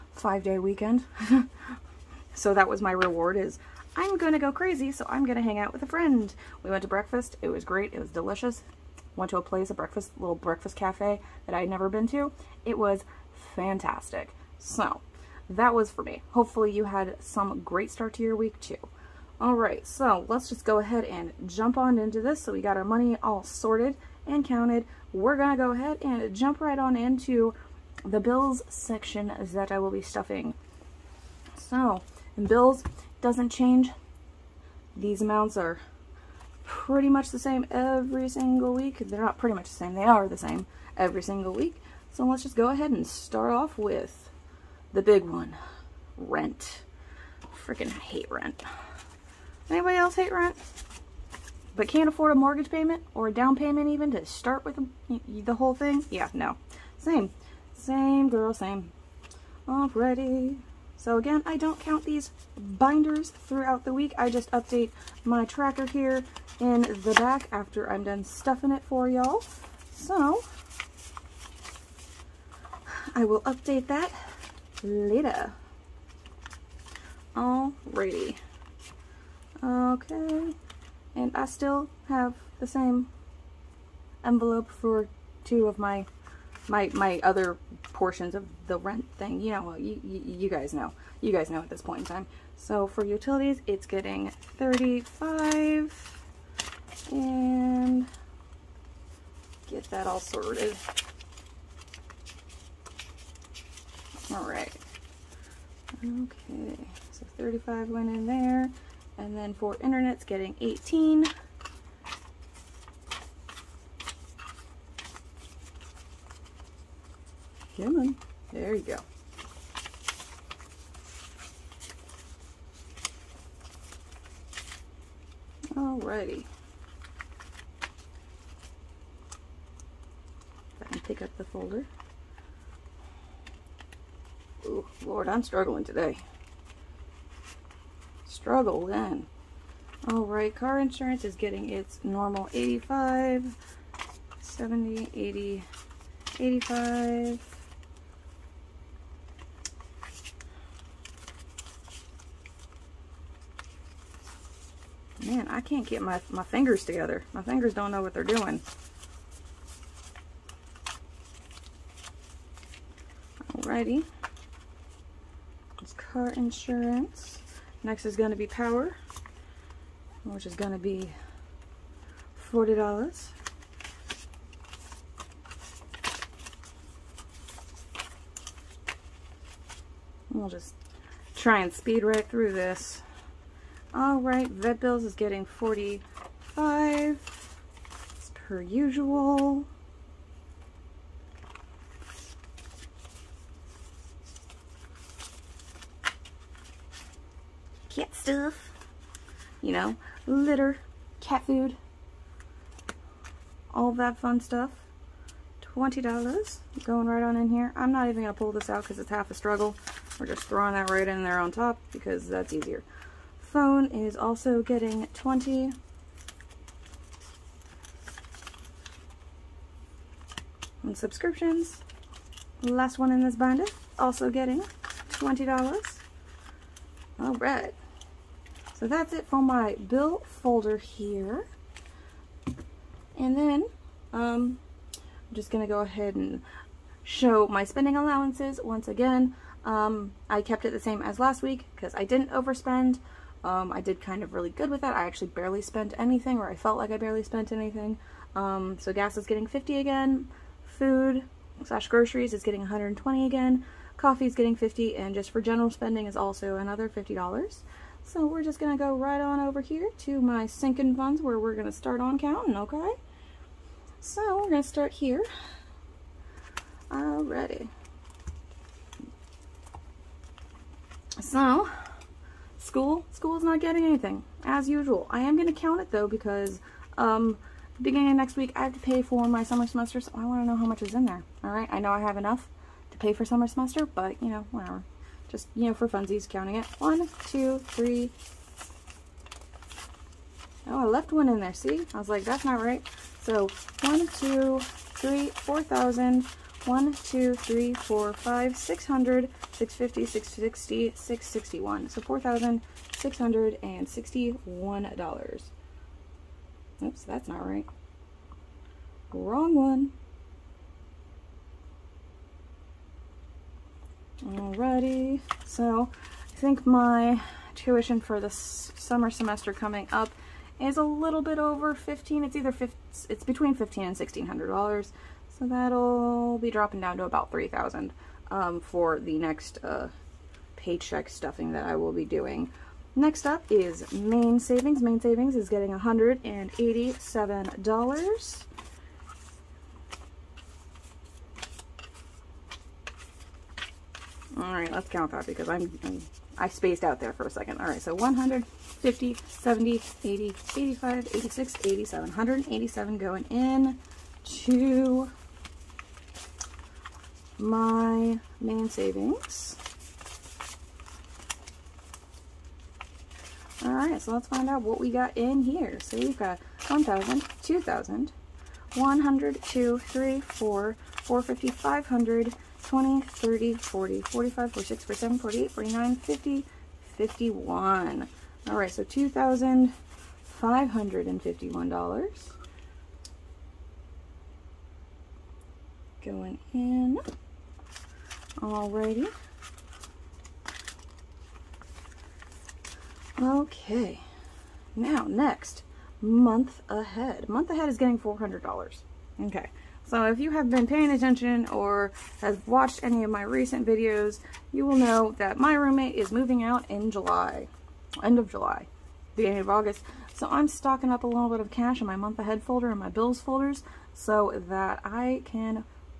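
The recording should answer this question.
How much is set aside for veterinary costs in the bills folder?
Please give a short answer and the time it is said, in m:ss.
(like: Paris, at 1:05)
$45, at 3:05.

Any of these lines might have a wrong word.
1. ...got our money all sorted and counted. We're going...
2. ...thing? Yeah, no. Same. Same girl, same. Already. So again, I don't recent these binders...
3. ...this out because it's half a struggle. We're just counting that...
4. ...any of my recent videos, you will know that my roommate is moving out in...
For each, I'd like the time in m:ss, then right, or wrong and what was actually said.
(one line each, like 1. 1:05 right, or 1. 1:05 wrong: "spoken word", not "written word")
1. 0:22 right
2. 0:55 wrong: "count", not "recent"
3. 3:28 wrong: "throwing", not "counting"
4. 6:42 right.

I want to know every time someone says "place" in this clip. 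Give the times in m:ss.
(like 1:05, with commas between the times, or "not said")
0:09.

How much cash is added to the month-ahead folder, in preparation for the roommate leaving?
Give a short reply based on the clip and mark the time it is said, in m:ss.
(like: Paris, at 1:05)
$400, at 6:37.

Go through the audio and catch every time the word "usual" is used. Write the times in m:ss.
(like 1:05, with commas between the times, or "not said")
3:08, 4:34.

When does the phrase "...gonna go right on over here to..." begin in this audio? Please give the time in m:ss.
4:18.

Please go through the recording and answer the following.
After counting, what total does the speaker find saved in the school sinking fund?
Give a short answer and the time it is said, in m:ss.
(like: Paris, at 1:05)
$4,661, at 5:02.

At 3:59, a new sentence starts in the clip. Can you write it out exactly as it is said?
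Um, I kept it the same as last week because I didn't overspend.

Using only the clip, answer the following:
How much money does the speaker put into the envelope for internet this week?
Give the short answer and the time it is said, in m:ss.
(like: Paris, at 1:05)
$18, at 1:50.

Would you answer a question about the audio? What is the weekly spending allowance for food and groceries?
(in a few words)
$120.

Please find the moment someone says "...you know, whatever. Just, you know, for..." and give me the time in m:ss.
4:44.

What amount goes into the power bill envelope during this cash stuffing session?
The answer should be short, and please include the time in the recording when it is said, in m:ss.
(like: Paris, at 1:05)
$40, at 2:52.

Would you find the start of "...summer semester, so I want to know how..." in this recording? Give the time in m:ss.
4:39.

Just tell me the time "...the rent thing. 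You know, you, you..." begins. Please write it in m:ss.
1:28.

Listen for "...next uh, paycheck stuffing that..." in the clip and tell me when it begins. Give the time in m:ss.
5:29.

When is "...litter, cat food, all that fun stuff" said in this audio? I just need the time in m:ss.
3:20.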